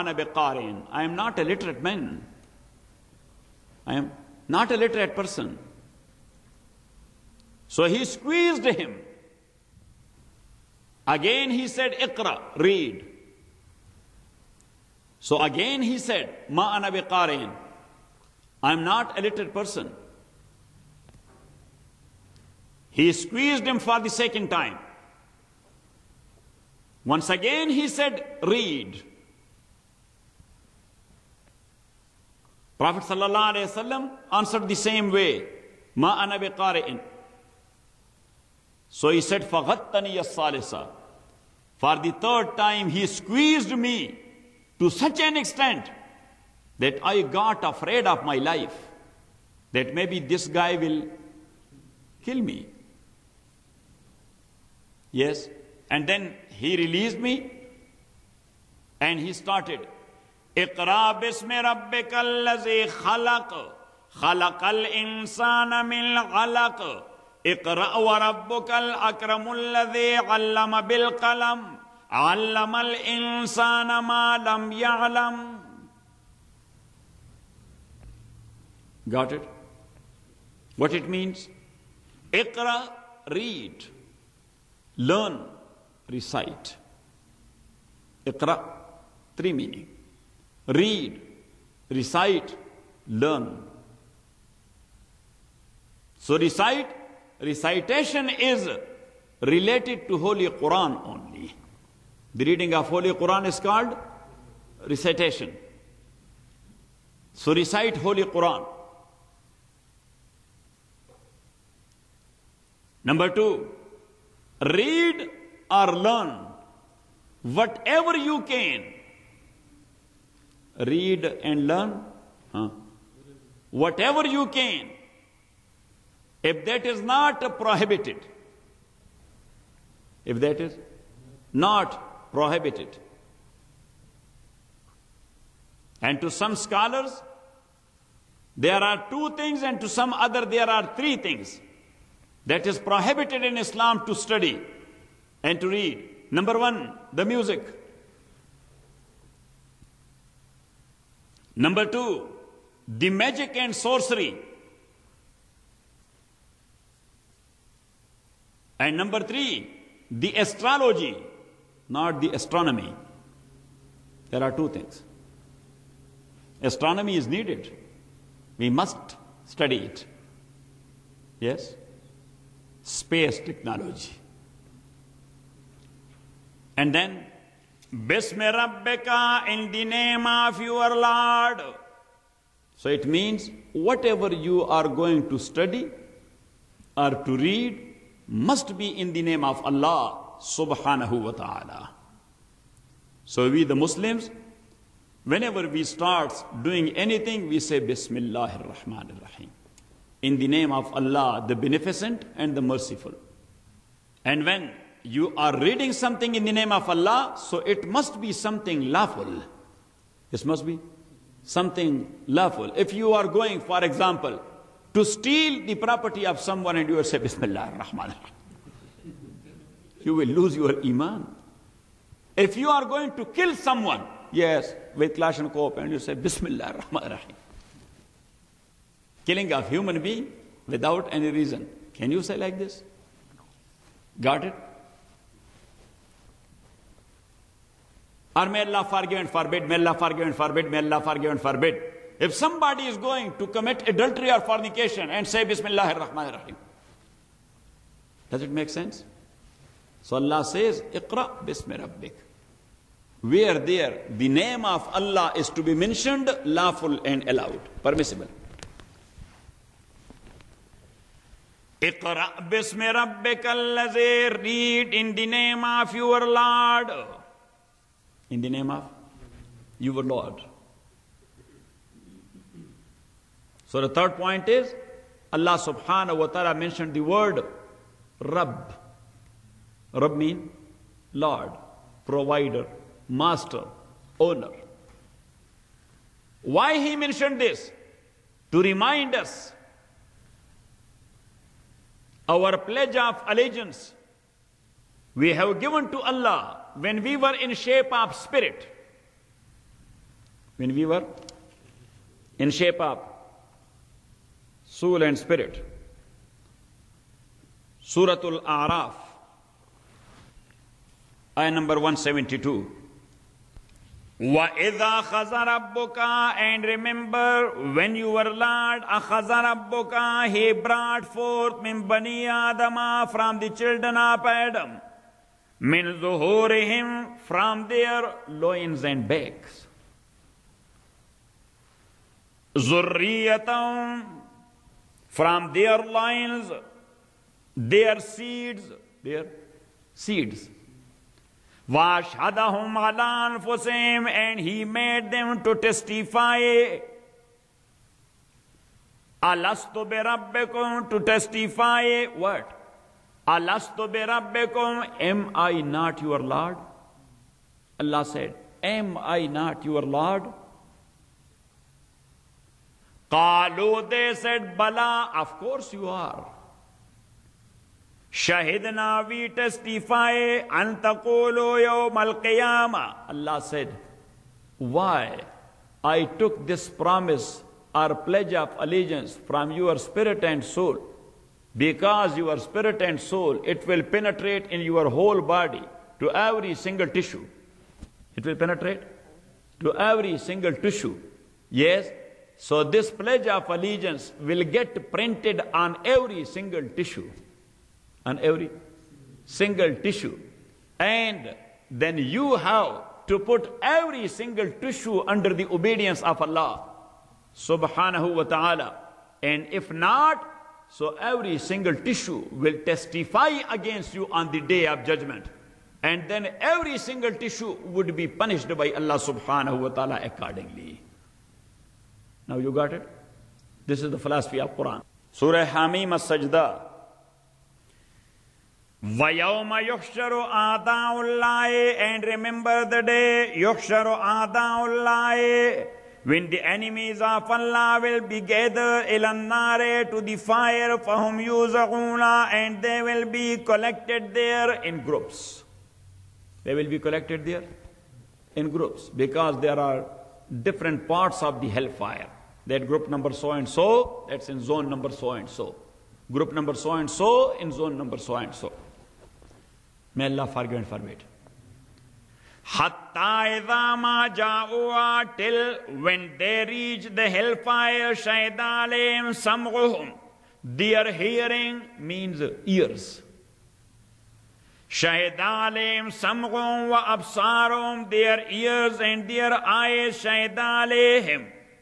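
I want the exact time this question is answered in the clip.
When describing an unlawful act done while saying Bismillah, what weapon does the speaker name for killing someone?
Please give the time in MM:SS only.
03:45.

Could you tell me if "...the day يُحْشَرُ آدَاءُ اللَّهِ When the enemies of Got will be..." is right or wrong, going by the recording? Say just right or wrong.
wrong.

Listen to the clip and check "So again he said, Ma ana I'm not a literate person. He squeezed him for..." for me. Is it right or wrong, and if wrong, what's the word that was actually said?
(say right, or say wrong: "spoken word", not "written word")
right.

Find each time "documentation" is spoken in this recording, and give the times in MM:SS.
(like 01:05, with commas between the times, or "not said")
not said.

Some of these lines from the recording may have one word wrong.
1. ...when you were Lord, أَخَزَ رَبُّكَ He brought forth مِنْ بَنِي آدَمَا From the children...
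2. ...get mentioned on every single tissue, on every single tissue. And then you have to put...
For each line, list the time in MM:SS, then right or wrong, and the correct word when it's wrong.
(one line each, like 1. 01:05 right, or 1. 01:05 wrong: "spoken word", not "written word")
1. 05:17 right
2. 06:34 wrong: "printed", not "mentioned".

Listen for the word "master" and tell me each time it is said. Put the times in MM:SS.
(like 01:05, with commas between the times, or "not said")
04:43.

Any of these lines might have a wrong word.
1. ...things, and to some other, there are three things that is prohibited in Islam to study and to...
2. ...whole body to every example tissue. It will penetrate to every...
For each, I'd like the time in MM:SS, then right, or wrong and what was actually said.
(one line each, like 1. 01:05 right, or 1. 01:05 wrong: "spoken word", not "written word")
1. 02:19 right
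2. 06:24 wrong: "single", not "example".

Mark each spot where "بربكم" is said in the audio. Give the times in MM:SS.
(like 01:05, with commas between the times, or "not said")
05:49, 05:53.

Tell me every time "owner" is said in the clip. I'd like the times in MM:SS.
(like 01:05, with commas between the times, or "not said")
04:44.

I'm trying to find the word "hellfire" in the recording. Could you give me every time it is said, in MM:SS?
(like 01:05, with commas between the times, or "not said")
07:31, 07:47.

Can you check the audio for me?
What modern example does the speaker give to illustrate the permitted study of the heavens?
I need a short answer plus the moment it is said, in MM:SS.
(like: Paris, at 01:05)
space technology, at 02:52.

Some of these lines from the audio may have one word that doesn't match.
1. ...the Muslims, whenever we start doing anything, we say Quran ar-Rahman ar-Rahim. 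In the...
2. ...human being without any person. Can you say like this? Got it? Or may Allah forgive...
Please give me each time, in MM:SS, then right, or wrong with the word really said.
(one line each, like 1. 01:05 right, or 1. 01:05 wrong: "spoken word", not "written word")
1. 03:13 wrong: "Bismillah", not "Quran"
2. 03:49 wrong: "reason", not "person".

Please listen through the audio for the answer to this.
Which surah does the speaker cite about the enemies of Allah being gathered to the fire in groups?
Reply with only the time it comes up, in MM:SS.
07:05.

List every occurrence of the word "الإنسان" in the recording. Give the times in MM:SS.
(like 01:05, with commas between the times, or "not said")
01:04, 01:12.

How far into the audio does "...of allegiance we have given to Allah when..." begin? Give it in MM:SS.
04:52.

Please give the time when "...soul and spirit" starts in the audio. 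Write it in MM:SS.
05:04.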